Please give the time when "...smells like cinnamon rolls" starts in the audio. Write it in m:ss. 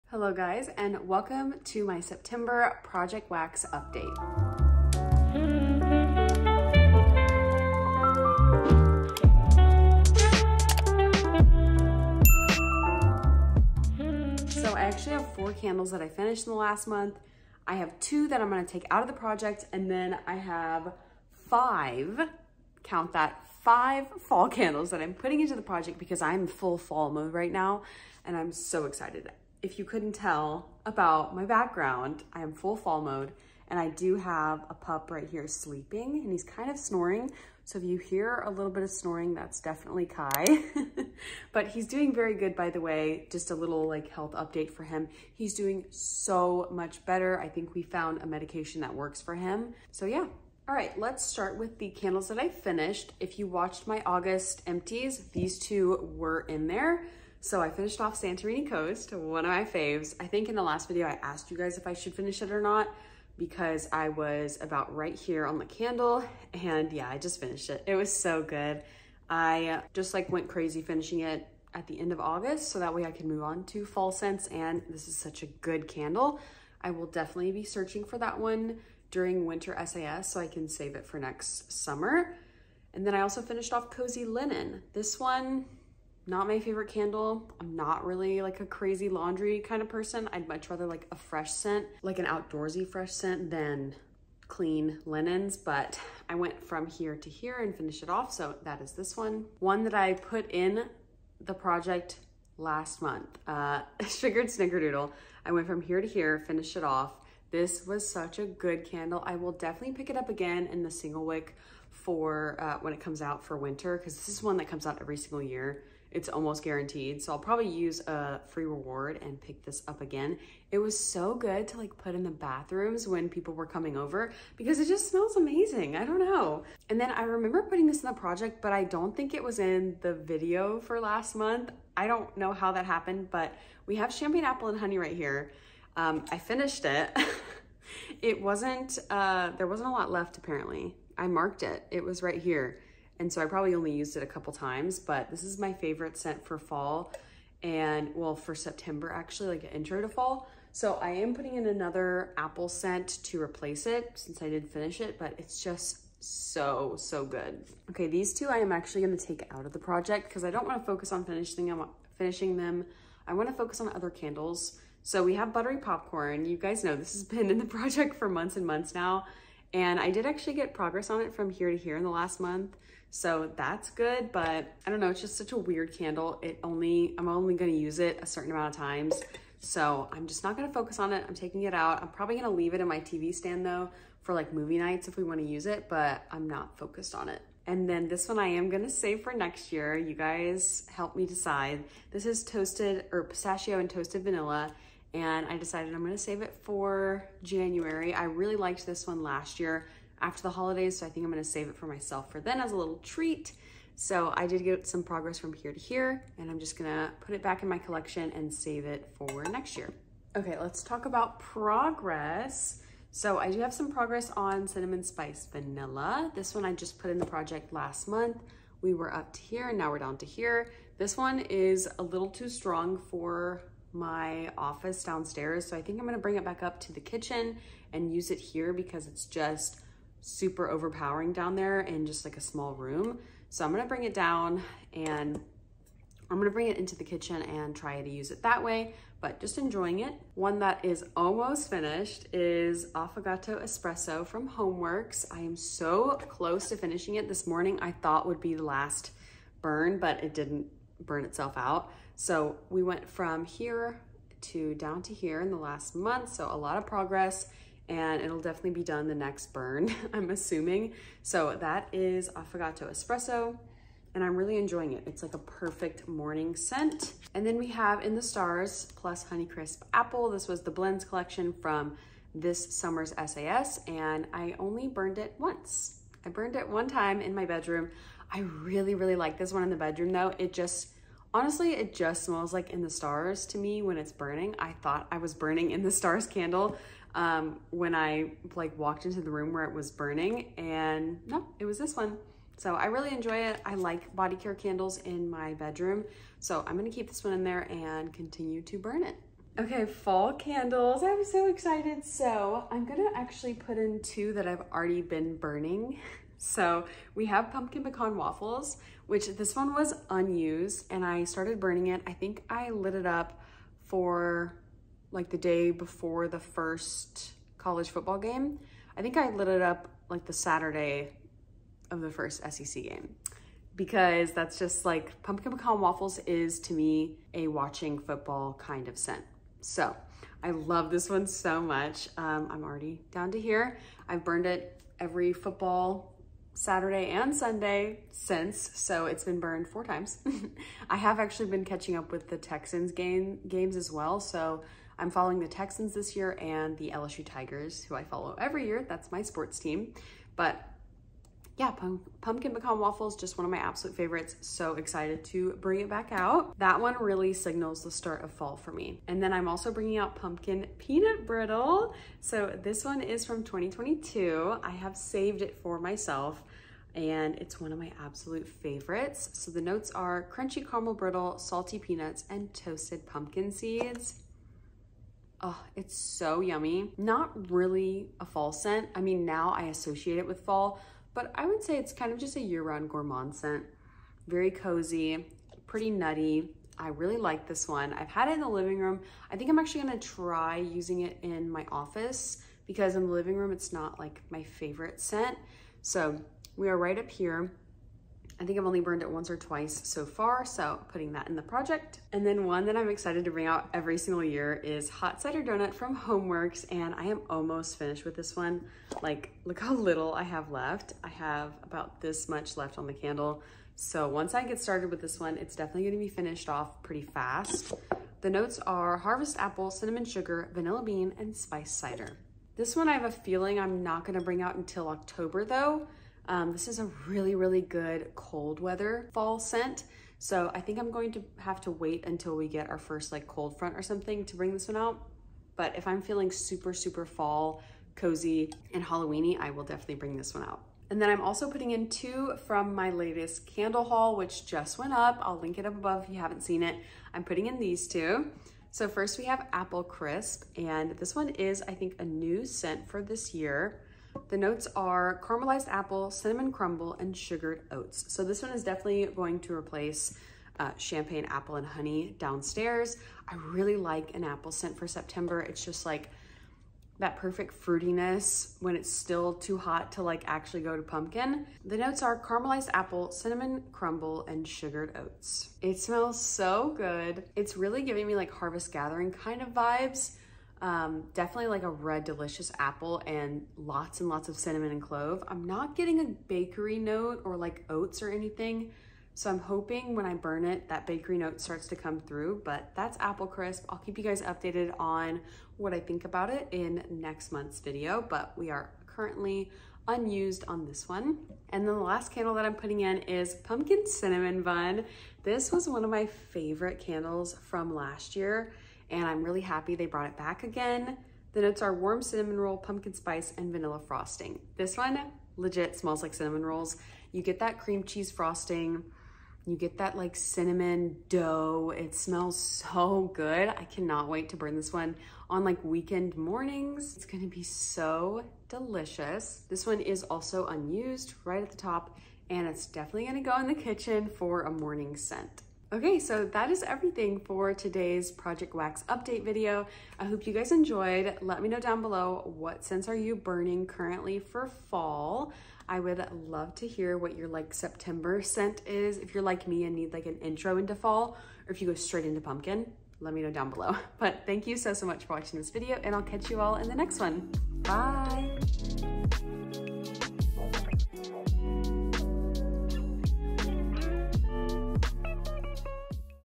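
8:35.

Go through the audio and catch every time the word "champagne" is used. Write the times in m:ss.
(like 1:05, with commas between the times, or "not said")
2:14, 7:40.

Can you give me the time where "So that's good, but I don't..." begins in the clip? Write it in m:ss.
2:53.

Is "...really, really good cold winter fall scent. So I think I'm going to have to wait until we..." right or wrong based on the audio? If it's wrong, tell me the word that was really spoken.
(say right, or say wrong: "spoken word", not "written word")
wrong: "weather", not "winter".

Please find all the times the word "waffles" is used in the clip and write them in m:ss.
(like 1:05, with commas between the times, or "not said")
5:08, 5:25, 5:52.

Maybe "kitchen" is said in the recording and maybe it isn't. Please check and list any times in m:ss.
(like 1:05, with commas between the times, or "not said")
3:46, 3:57, 8:53.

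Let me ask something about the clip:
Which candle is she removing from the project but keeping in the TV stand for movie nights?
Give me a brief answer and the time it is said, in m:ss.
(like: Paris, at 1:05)
Buttery Popcorn, at 2:45.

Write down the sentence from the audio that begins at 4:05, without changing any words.
I am so close to finishing it this morning.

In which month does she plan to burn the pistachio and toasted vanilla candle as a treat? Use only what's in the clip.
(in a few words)
January.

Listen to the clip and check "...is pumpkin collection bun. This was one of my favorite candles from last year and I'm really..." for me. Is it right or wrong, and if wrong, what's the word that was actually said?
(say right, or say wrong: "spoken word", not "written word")
wrong: "cinnamon", not "collection".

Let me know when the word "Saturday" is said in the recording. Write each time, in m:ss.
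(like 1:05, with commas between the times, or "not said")
5:20, 5:36.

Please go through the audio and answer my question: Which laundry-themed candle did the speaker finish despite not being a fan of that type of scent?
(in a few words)
Cozy Linen.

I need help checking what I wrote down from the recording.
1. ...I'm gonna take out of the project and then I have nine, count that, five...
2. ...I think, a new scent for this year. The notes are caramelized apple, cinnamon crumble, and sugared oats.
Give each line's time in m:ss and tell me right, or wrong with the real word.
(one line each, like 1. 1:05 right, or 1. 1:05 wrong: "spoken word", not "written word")
1. 0:18 wrong: "five", not "nine"
2. 7:31 right.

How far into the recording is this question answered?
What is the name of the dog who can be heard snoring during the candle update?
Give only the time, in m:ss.
0:40.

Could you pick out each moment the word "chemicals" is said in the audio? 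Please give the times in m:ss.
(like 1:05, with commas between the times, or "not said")
not said.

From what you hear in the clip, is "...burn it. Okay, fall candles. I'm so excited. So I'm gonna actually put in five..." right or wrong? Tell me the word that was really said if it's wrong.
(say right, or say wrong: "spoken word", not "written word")
wrong: "two", not "five".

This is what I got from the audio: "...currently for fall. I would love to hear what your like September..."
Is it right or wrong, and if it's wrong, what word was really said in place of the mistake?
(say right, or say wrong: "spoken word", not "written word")
right.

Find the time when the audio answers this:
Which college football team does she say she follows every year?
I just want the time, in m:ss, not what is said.
5:46.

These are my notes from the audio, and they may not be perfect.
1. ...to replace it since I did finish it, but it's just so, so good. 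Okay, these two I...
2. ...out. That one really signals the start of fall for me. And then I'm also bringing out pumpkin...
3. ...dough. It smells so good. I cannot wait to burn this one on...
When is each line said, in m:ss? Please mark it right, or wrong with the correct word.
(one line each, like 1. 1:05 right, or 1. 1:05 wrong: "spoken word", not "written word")
1. 2:33 right
2. 5:56 right
3. 8:41 right.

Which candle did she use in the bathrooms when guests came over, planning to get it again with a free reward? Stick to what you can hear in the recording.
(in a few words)
Sugared Snickerdoodle.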